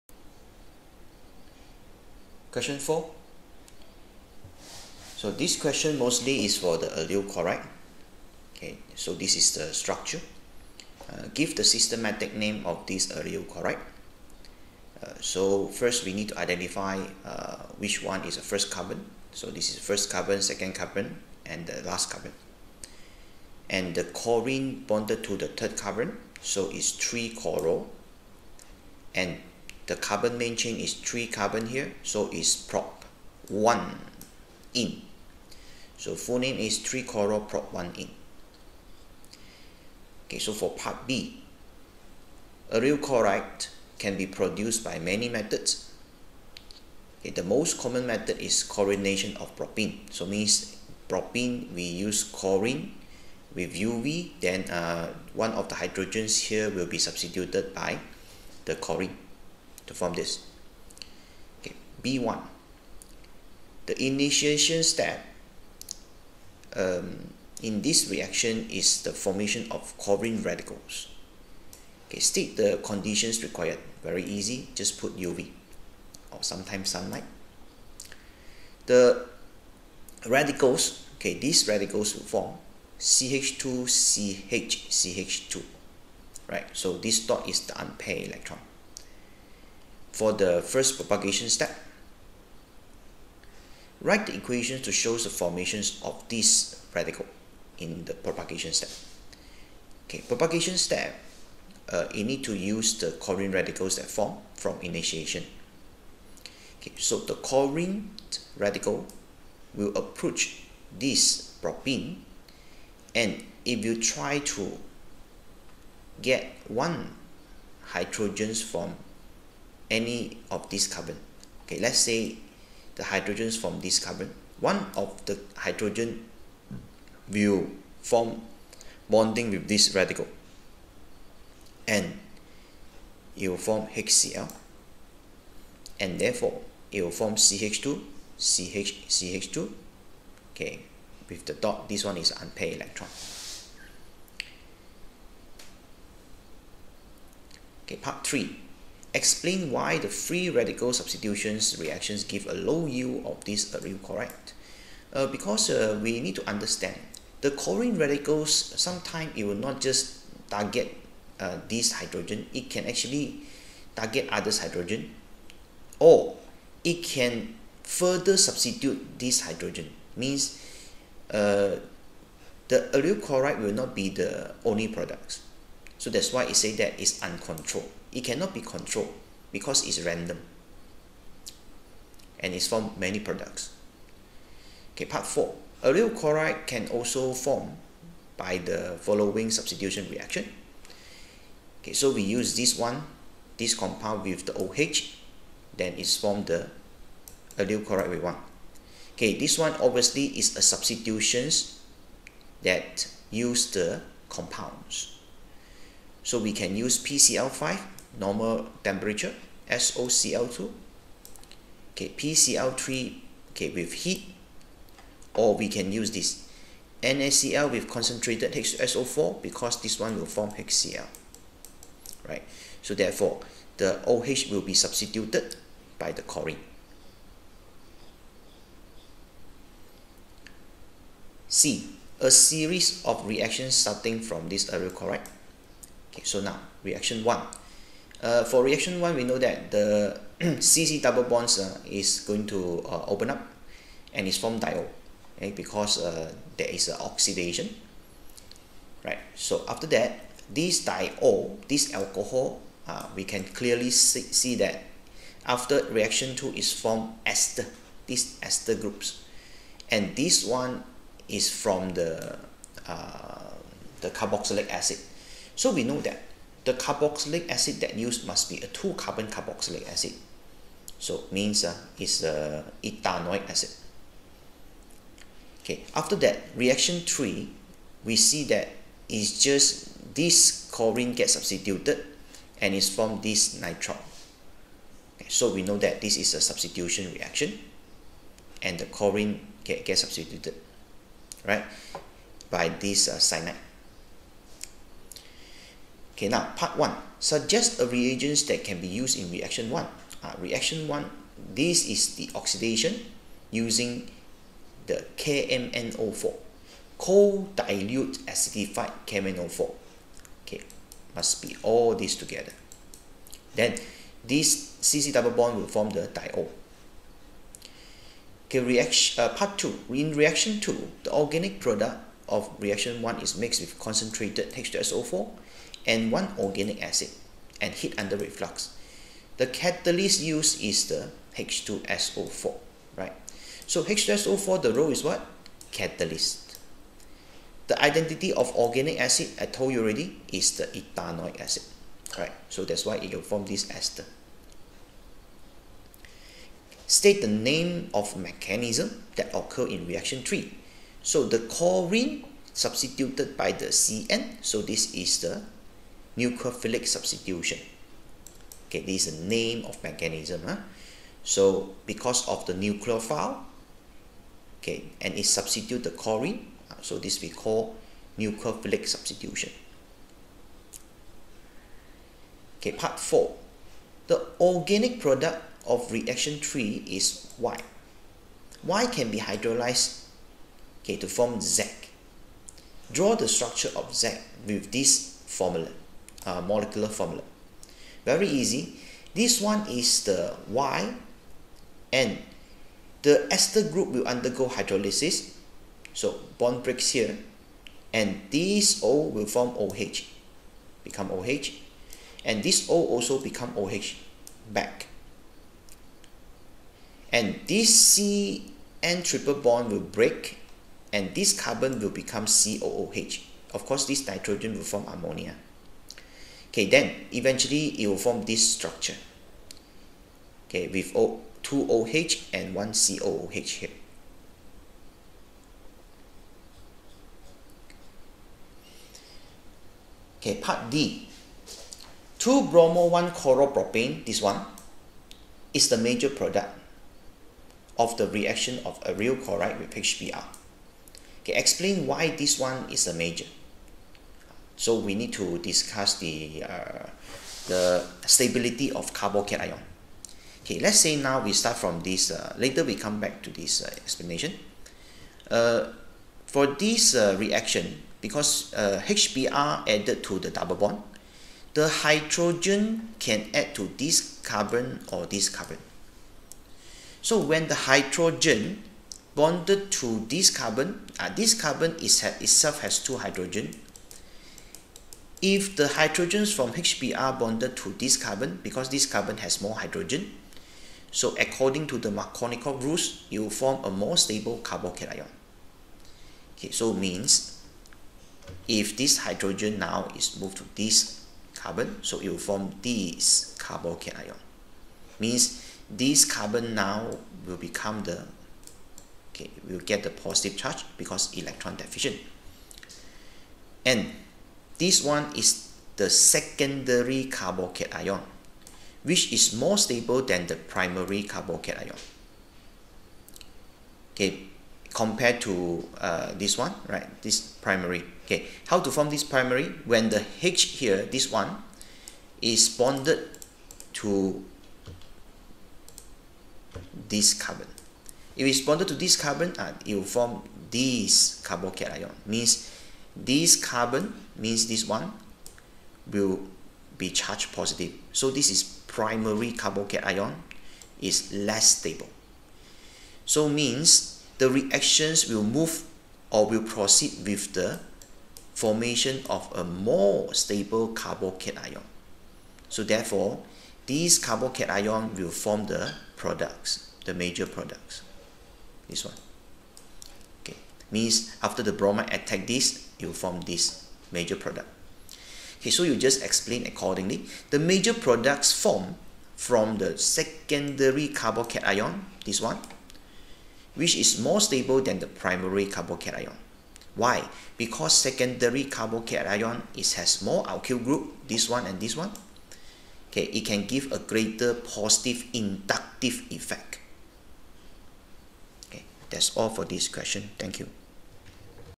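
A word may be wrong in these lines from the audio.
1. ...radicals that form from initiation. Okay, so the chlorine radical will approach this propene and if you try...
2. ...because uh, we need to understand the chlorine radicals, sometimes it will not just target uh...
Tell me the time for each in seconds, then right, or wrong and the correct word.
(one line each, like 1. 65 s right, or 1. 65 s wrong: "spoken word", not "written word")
1. 103 s right
2. 155 s right.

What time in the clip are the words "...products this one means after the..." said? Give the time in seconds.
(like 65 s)
557 s.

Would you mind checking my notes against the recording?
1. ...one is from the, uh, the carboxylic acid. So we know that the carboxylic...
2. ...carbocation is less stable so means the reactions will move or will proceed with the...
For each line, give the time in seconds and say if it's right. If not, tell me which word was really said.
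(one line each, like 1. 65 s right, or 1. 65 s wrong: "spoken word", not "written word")
1. 260 s right
2. 539 s right.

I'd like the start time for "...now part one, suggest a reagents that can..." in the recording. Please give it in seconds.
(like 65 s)
296 s.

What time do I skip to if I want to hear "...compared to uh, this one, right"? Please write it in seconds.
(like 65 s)
514 s.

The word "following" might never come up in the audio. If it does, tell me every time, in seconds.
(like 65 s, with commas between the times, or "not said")
188 s.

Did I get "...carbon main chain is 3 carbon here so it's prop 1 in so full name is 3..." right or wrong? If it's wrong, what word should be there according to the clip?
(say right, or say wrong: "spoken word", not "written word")
right.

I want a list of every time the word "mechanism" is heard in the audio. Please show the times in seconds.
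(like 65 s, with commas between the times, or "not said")
348 s, 359 s.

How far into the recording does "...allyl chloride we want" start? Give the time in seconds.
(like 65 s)
197 s.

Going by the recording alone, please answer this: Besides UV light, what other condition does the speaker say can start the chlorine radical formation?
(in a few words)
sunlight.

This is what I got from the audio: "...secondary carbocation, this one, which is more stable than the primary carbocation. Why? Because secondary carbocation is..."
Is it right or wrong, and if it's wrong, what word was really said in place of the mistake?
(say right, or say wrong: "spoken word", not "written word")
right.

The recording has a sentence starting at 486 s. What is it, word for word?
Okay, so means if this hydrogen now is moved to this carbon, so it will form this carbocation.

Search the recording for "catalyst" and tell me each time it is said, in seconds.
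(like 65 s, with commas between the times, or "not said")
329 s, 335 s.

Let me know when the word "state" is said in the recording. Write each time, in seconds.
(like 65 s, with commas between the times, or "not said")
72 s, 346 s.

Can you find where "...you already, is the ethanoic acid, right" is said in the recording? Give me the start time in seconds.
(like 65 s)
339 s.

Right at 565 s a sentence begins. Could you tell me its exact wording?
Okay, so you just explain accordingly.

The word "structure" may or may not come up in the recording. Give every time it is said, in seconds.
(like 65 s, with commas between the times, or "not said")
9 s, 383 s, 418 s.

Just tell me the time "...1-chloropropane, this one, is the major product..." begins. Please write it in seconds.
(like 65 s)
432 s.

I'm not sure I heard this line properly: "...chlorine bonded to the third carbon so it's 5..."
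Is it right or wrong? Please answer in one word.
wrong.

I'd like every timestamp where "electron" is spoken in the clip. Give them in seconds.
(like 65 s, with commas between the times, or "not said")
88 s, 142 s, 501 s.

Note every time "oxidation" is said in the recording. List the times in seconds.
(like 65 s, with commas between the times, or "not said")
247 s, 302 s.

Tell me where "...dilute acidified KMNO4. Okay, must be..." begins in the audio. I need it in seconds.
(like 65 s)
307 s.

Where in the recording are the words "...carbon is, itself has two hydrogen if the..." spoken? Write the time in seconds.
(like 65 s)
471 s.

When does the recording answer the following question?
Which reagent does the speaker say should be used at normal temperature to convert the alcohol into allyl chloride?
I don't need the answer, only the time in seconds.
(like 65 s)
207 s.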